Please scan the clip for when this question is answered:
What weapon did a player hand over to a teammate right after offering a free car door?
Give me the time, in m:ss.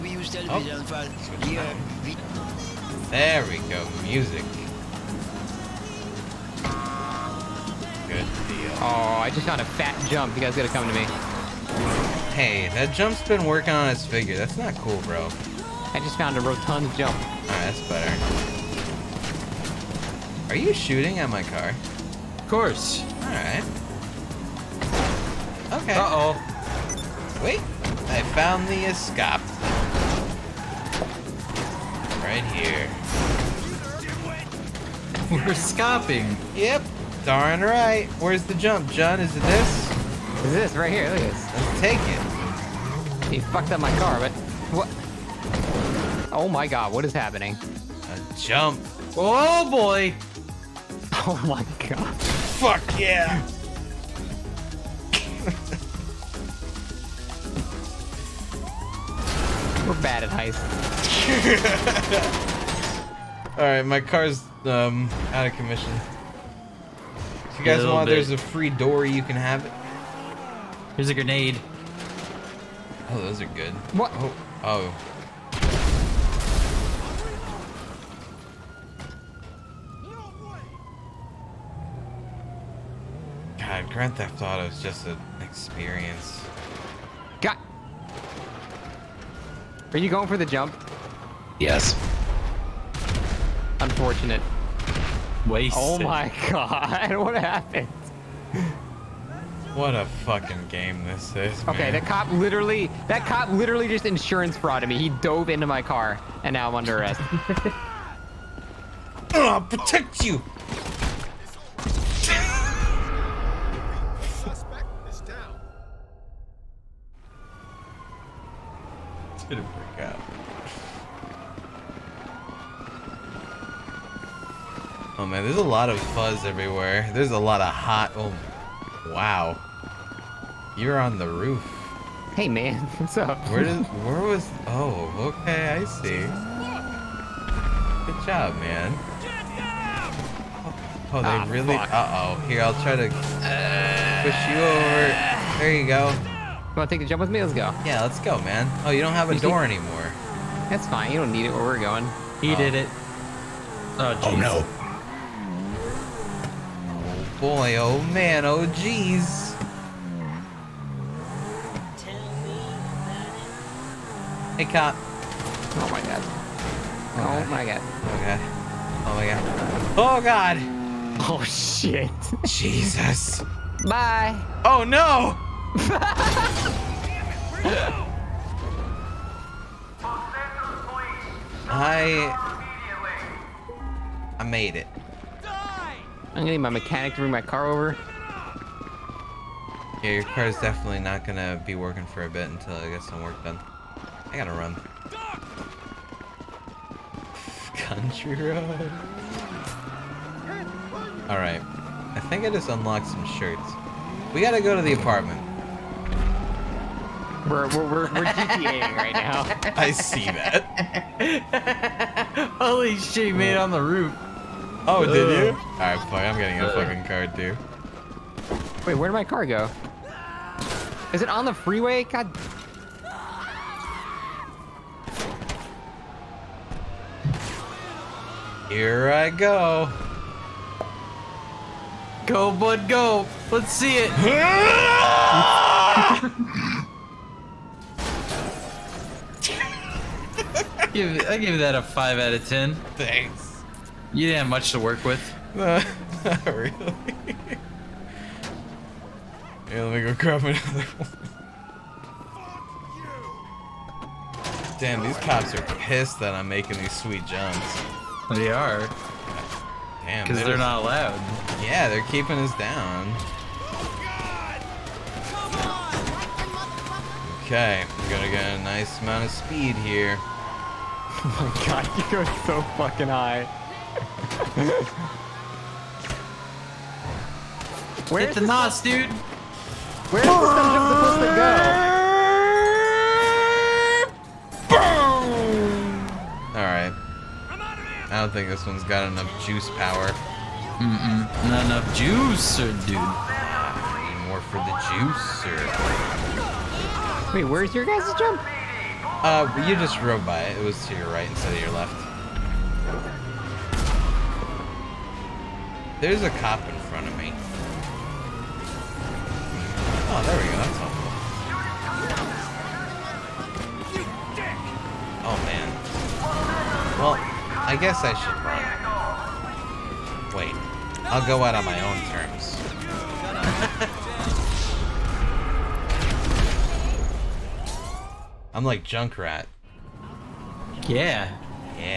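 1:11.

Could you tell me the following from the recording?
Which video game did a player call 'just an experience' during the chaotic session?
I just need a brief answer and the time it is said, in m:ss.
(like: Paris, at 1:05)
Grand Theft Auto, at 1:23.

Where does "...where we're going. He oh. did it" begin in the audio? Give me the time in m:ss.
2:31.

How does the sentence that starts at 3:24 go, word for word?
We gotta go to the apartment.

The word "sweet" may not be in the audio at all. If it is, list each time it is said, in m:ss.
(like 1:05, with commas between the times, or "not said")
4:16.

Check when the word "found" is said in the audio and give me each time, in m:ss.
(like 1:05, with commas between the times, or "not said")
0:09, 0:16, 0:28.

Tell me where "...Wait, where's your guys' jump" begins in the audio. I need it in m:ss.
4:57.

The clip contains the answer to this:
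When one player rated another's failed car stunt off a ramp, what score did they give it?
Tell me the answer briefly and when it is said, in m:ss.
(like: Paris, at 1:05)
5 out of 10, at 4:01.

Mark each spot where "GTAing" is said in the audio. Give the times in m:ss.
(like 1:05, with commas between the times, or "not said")
3:28.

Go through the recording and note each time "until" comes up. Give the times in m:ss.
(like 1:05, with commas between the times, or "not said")
3:12.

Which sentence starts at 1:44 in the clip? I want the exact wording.
He dove into my car and now I'm under arrest.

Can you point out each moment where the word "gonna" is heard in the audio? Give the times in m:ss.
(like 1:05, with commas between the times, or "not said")
3:06, 3:11.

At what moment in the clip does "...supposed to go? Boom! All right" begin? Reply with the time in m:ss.
4:44.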